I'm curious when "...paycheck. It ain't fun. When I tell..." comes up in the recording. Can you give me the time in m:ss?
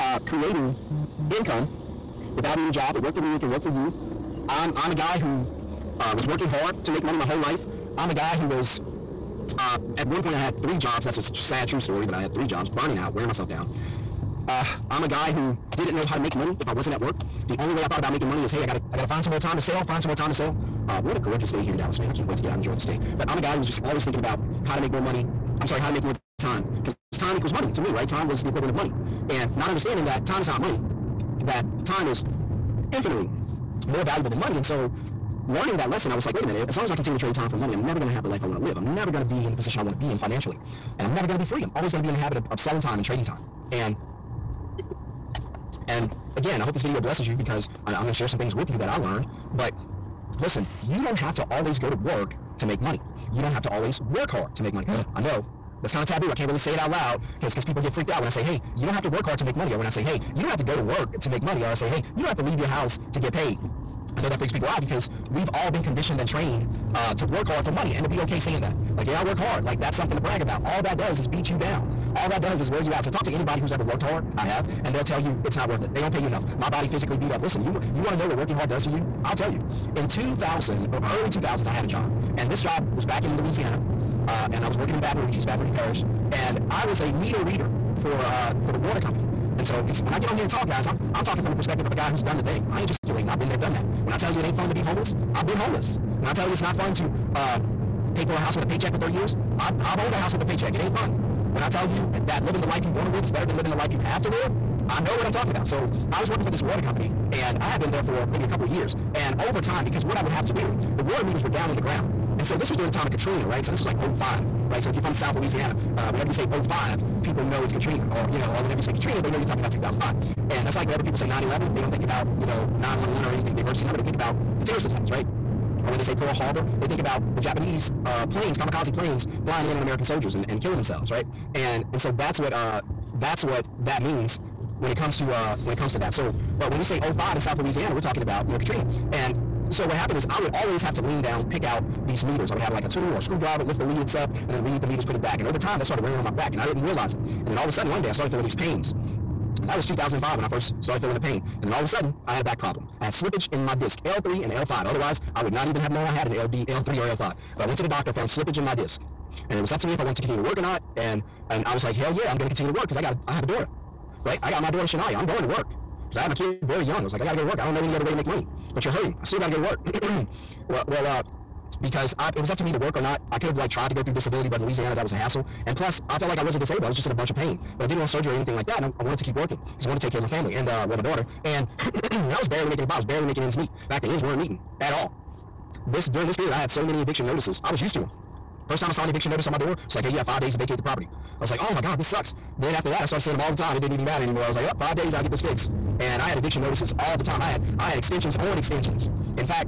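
1:40.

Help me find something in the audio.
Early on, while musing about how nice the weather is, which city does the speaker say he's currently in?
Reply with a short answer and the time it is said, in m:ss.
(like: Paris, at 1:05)
Dallas, at 0:21.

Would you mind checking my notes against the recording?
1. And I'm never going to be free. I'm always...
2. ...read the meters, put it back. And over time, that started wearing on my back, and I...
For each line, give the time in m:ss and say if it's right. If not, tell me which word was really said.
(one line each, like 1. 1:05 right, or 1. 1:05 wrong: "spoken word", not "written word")
1. 0:40 right
2. 2:24 right.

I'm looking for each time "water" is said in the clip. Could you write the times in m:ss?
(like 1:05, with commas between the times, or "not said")
1:28, 1:46, 1:51.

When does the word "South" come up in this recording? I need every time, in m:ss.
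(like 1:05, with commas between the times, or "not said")
1:55, 2:17.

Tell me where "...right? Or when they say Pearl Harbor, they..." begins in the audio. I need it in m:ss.
2:05.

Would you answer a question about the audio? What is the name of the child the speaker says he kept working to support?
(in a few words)
Shania.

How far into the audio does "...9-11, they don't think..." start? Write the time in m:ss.
2:01.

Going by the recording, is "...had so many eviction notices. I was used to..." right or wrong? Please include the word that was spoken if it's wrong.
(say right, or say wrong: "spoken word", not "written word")
right.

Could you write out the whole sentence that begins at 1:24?
Uh, and I was working in Baton Rouge, East Baton Rouge Parish.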